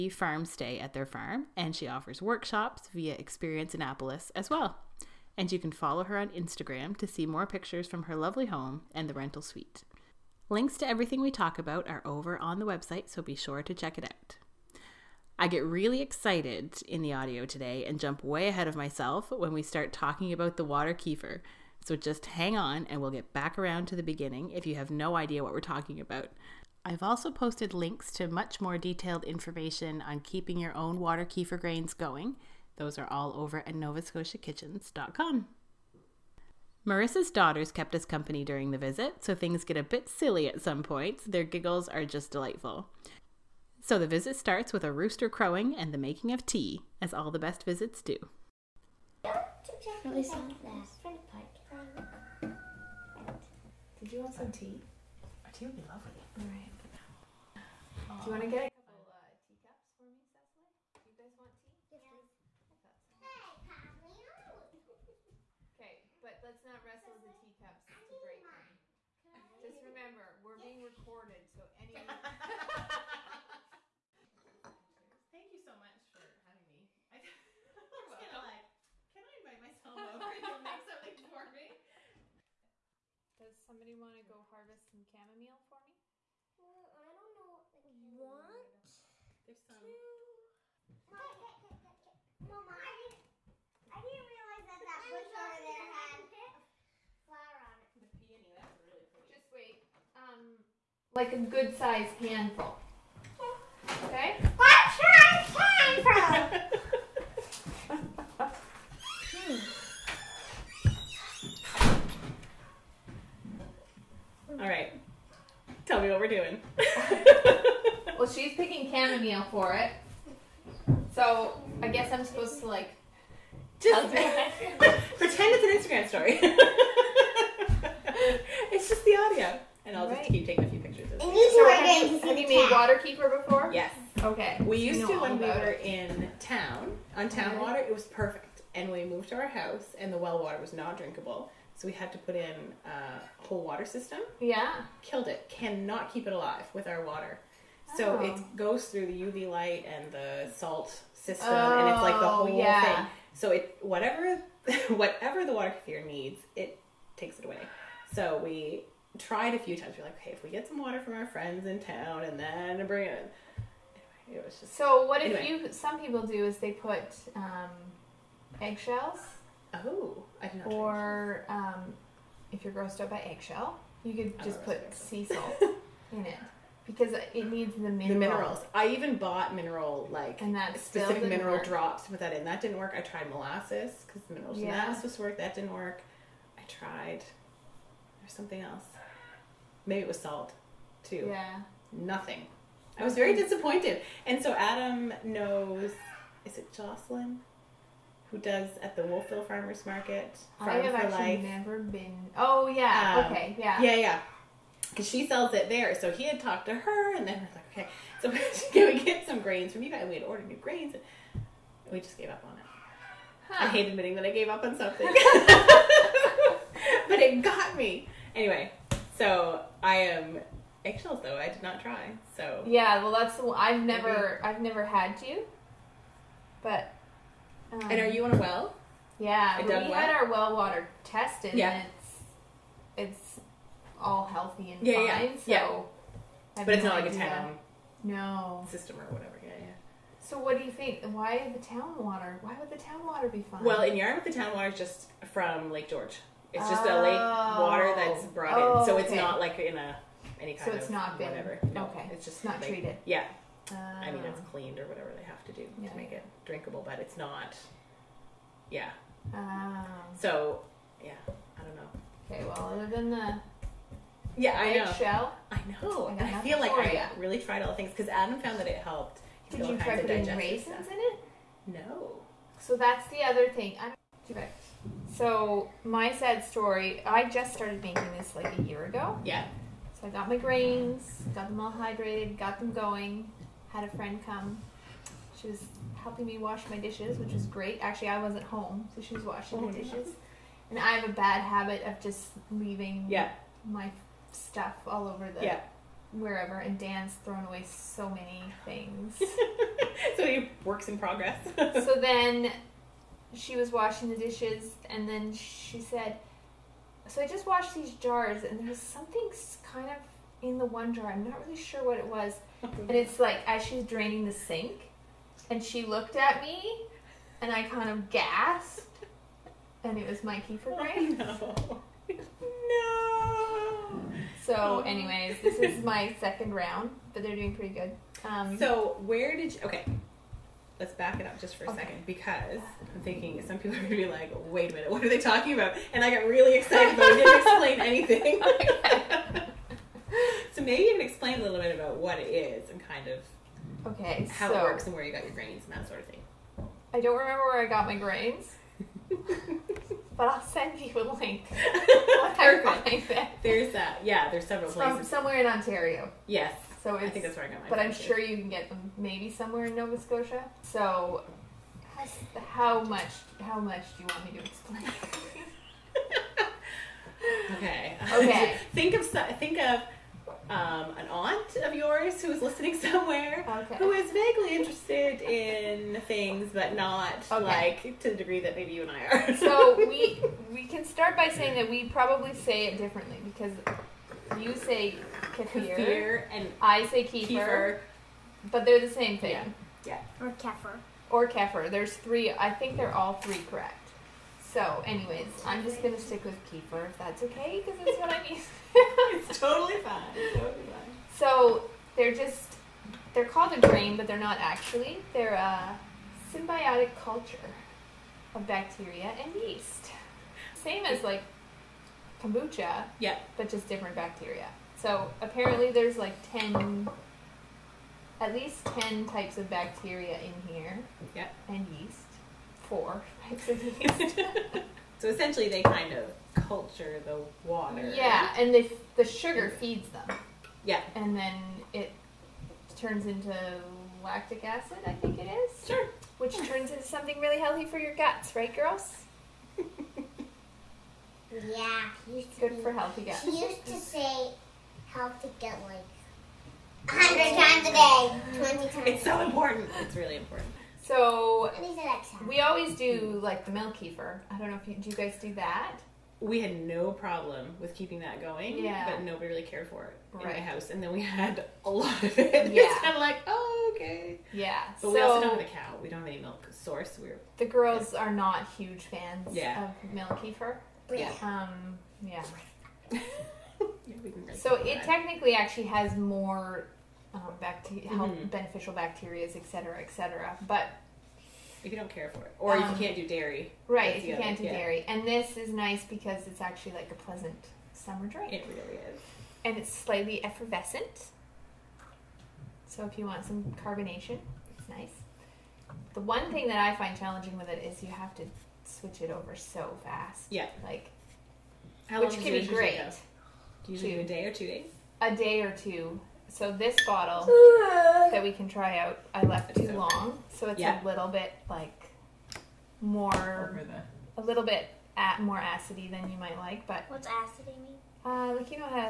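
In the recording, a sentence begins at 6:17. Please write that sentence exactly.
like to the degree that maybe you and I are.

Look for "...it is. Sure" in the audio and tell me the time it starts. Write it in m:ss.
7:15.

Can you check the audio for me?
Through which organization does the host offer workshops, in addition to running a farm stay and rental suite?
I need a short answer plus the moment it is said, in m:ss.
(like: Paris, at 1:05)
Experience Annapolis, at 0:03.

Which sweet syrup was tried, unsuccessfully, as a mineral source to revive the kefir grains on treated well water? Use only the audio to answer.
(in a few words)
molasses.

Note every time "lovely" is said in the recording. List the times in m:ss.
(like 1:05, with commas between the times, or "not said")
0:08, 0:55.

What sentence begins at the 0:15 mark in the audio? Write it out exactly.
I get really excited in the audio today and jump way ahead of myself when we start talking about the water kefir.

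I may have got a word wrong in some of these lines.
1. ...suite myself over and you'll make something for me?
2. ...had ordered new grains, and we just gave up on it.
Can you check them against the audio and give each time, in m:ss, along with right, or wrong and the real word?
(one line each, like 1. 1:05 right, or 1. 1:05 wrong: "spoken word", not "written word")
1. 1:19 wrong: "invite", not "suite"
2. 3:30 right.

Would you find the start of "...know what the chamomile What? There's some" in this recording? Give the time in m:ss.
1:27.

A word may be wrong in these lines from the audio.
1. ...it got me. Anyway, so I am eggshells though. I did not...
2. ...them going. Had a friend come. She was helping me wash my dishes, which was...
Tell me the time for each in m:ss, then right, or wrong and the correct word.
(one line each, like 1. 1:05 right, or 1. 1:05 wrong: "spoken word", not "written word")
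1. 3:37 right
2. 4:42 right.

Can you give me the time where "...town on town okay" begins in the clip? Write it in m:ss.
2:16.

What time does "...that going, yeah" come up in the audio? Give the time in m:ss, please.
7:37.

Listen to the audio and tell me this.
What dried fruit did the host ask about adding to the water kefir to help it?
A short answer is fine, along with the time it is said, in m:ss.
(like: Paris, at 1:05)
raisins, at 4:30.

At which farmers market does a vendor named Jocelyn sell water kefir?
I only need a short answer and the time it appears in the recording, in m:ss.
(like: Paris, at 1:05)
Wolfville Farmers Market, at 3:19.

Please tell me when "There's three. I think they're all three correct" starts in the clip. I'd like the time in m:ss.
6:31.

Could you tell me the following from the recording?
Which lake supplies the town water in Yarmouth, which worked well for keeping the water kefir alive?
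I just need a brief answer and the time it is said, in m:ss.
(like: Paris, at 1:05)
Lake George, at 4:05.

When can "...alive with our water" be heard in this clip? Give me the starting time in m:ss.
2:26.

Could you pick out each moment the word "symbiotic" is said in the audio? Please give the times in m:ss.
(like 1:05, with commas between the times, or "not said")
6:46.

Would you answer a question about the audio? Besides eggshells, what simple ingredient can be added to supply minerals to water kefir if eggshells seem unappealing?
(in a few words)
sea salt.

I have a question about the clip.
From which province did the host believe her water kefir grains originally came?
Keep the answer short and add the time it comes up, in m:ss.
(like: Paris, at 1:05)
Ontario, at 5:55.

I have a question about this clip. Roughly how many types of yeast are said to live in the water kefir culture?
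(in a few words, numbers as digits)
4.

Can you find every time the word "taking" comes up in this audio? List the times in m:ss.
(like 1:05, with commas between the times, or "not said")
2:10.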